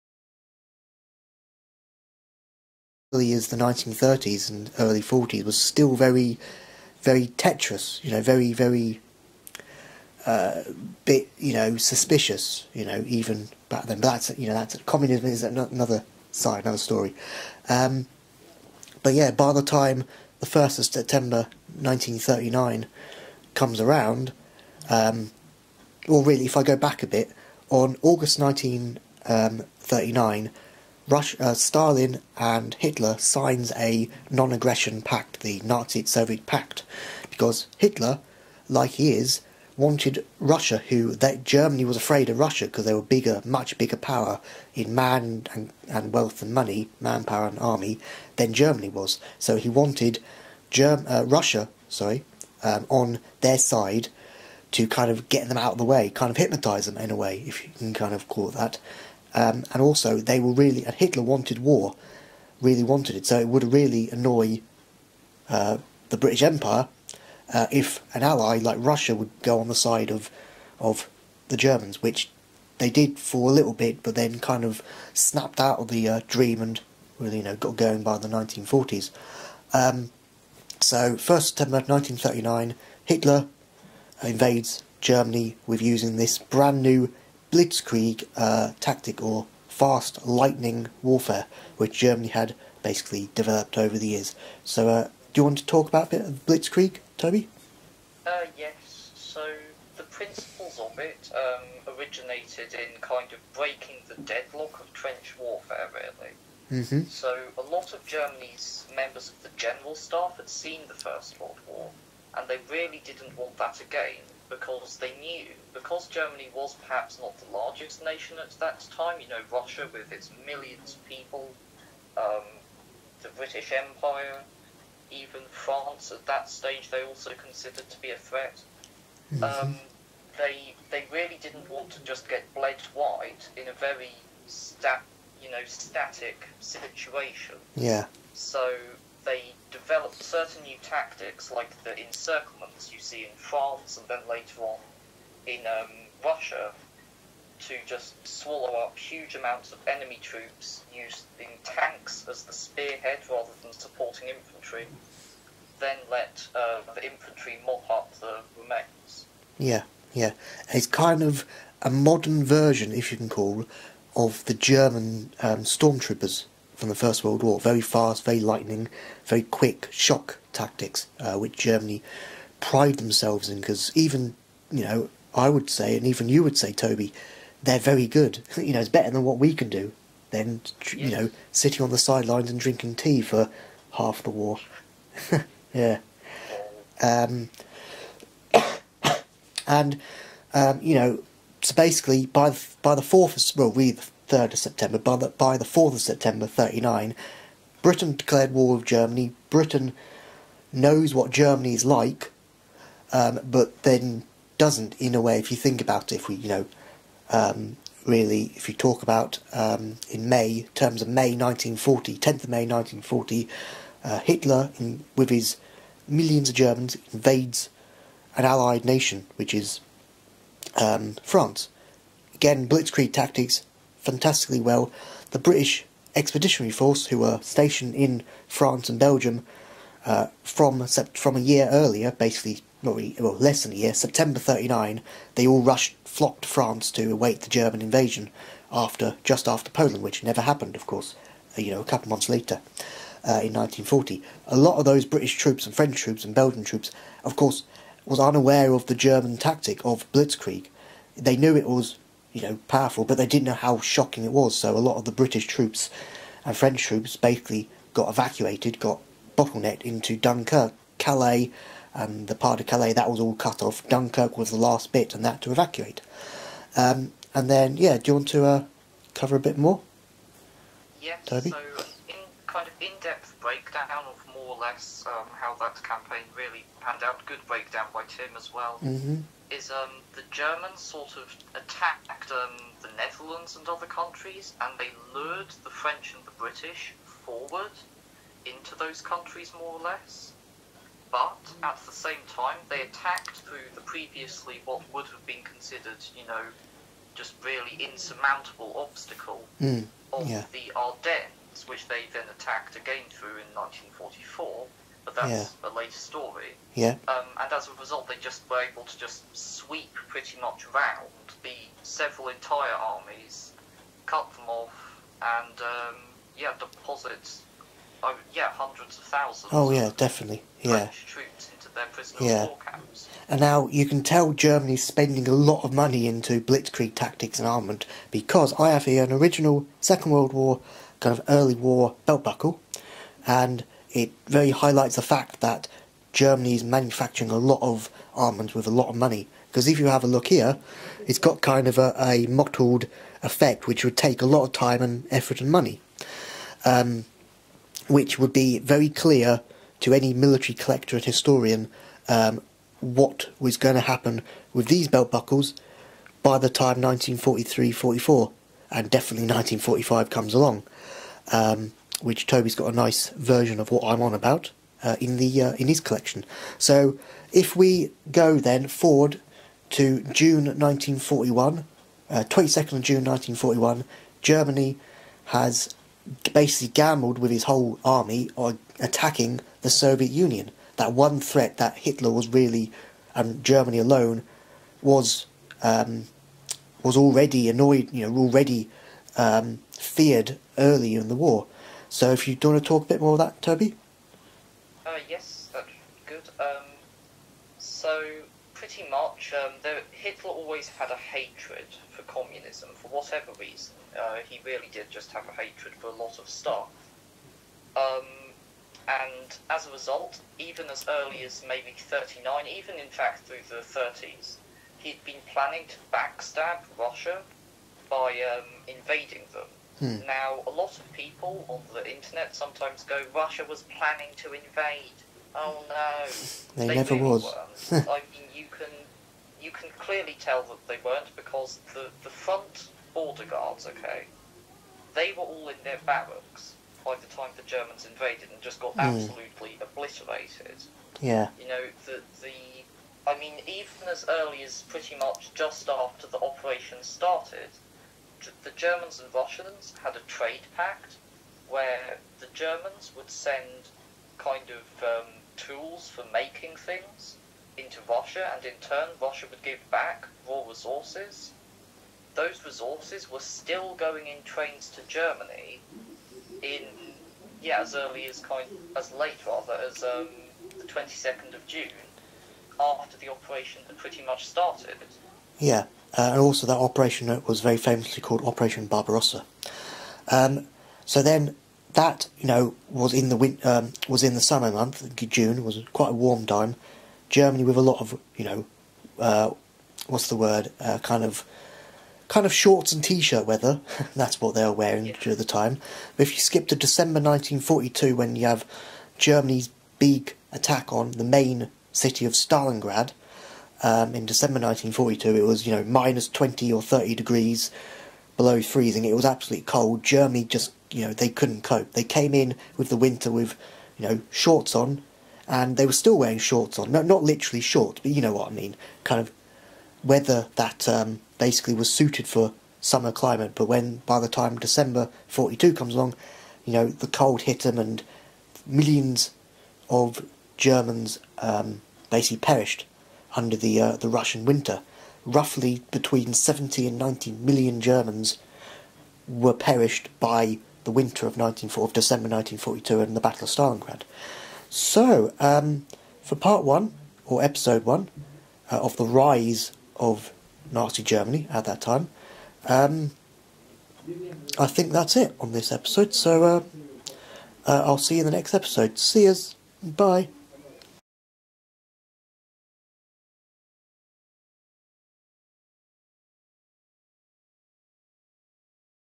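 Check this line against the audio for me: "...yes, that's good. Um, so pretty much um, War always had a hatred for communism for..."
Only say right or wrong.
wrong.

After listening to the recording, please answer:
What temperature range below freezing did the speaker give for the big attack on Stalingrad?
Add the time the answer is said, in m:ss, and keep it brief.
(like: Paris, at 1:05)
minus 20 or 30 degrees, at 8:25.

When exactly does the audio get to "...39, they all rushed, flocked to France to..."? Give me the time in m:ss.
3:54.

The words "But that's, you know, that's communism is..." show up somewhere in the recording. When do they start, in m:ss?
0:13.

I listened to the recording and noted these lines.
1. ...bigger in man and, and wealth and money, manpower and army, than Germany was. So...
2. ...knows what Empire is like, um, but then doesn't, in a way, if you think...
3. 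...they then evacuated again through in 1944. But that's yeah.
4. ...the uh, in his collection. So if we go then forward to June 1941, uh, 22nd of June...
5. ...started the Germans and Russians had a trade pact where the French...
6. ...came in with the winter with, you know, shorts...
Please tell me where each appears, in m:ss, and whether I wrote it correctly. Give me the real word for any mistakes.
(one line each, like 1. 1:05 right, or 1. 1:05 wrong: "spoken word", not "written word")
1. 0:43 wrong: "power", not "bigger"
2. 3:20 wrong: "Germany", not "Empire"
3. 5:01 wrong: "attacked", not "evacuated"
4. 6:05 right
5. 7:26 wrong: "Germans", not "French"
6. 8:31 right.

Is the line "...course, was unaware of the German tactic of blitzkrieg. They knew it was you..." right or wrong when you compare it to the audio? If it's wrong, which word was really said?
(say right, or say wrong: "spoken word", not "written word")
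right.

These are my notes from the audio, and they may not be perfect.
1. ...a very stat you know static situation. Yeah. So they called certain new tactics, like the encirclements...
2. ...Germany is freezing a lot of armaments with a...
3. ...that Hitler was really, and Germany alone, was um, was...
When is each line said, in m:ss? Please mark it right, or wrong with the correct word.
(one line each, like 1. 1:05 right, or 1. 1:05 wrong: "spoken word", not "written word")
1. 2:13 wrong: "developed", not "called"
2. 5:36 wrong: "manufacturing", not "freezing"
3. 6:21 right.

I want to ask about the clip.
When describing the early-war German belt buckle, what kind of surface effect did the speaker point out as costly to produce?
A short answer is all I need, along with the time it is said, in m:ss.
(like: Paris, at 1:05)
mottled effect, at 5:42.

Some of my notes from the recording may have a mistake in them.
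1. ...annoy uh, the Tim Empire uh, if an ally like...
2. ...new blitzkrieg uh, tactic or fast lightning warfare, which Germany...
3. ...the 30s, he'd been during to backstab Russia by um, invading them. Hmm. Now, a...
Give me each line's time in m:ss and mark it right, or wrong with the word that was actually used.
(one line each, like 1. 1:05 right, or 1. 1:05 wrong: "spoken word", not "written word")
1. 1:04 wrong: "British", not "Tim"
2. 1:26 right
3. 6:53 wrong: "planning", not "during".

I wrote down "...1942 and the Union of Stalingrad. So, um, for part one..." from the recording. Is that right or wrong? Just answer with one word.
wrong.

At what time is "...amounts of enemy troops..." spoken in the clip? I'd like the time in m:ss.
2:29.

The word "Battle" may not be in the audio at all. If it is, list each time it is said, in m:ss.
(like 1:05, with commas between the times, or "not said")
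9:03.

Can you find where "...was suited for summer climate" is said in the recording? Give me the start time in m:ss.
8:41.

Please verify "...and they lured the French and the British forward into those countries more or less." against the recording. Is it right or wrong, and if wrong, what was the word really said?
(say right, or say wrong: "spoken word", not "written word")
right.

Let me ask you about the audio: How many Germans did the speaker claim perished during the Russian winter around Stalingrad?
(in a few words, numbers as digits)
70 to 90 million.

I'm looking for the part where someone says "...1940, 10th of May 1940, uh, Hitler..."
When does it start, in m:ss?
3:31.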